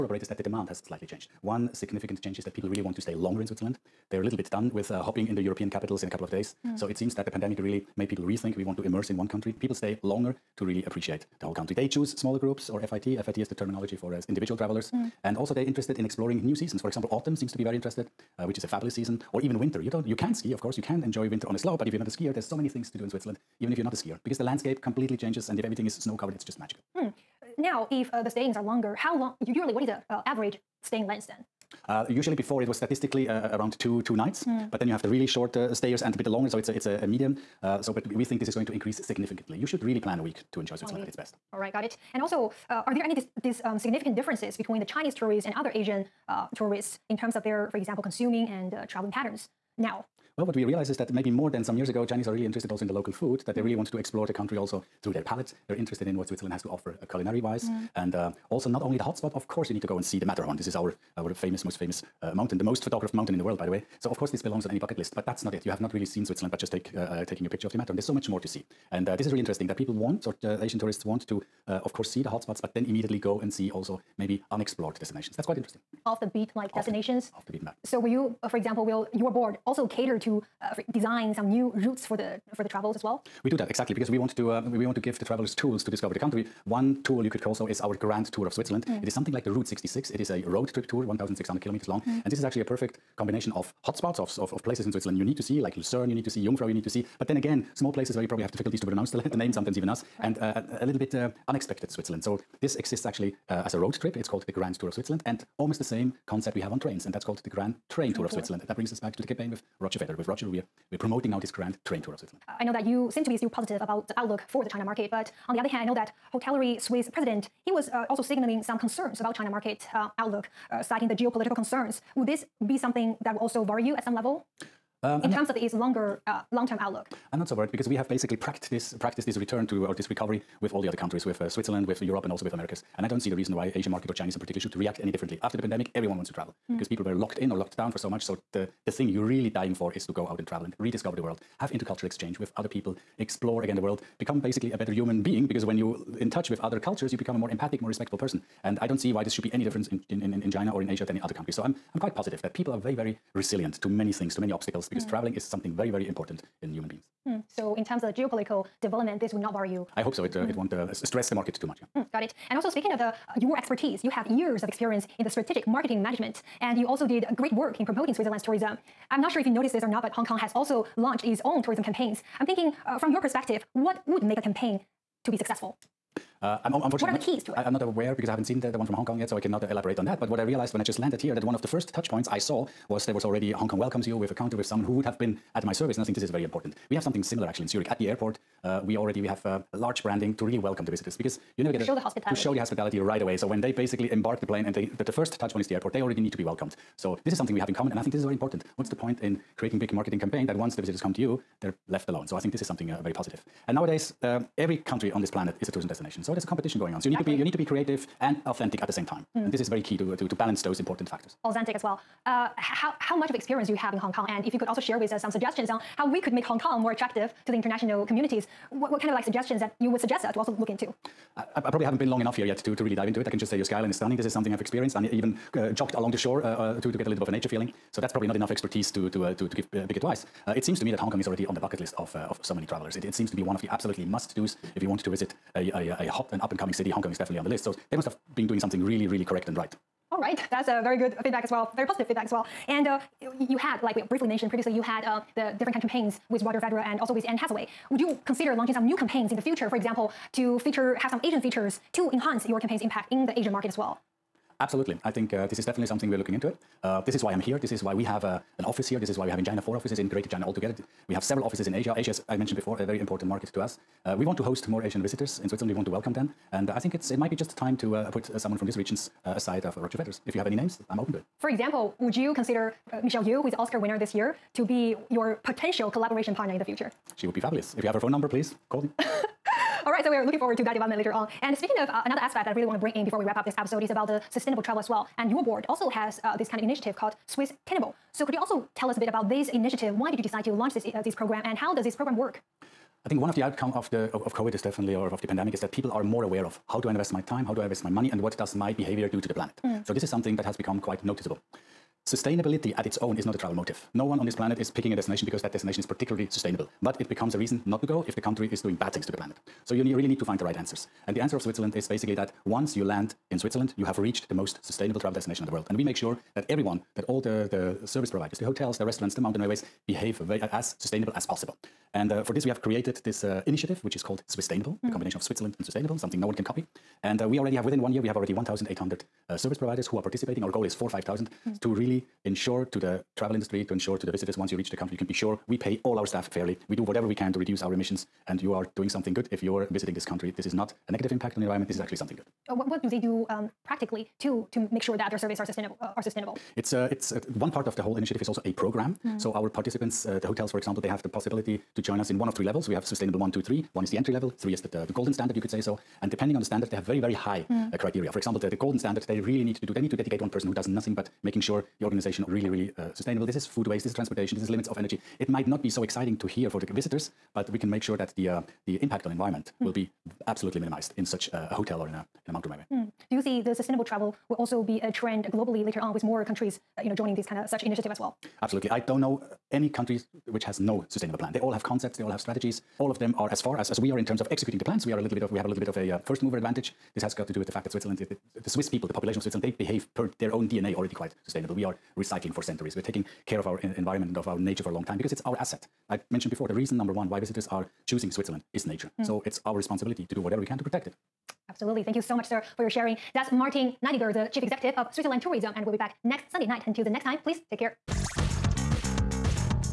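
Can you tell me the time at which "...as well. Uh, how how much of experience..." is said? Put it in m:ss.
3:31.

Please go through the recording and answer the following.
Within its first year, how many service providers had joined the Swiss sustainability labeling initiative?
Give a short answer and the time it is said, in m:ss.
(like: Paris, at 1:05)
1,800, at 5:28.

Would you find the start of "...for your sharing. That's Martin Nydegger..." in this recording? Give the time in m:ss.
6:42.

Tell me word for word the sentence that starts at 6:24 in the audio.
We are a little bit of we have a little bit of a uh, first mover advantage.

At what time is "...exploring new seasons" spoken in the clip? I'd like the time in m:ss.
0:16.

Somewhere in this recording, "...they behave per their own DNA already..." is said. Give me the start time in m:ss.
6:29.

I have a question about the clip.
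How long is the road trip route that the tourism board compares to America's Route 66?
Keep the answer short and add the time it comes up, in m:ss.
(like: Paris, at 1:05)
1,600 kilometers, at 1:31.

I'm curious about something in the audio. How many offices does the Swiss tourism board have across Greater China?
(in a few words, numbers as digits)
4.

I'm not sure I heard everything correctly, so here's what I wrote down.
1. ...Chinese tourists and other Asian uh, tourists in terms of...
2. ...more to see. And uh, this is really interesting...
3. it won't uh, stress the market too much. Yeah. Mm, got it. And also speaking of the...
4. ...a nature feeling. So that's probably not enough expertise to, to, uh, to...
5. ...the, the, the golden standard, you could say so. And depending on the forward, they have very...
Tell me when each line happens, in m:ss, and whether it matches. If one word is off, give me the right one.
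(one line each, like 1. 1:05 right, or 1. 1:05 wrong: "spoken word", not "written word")
1. 0:44 right
2. 1:08 right
3. 2:40 right
4. 3:47 right
5. 5:54 wrong: "standard", not "forward".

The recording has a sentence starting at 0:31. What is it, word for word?
Uh, usually before it was statistically uh, uh around two two nights, mm.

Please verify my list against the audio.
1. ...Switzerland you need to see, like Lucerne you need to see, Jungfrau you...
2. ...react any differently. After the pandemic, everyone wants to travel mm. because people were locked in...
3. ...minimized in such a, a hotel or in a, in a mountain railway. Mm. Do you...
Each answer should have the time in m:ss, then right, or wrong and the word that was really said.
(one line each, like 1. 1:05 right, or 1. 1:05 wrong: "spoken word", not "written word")
1. 1:34 right
2. 2:14 right
3. 6:10 right.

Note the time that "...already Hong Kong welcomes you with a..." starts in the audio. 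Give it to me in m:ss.
3:03.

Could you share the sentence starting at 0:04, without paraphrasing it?
They're a little bit done with uh, hopping the European capitals in a couple of days.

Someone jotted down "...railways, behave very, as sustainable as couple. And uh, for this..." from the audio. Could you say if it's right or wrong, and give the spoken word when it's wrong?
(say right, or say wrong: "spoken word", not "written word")
wrong: "possible", not "couple".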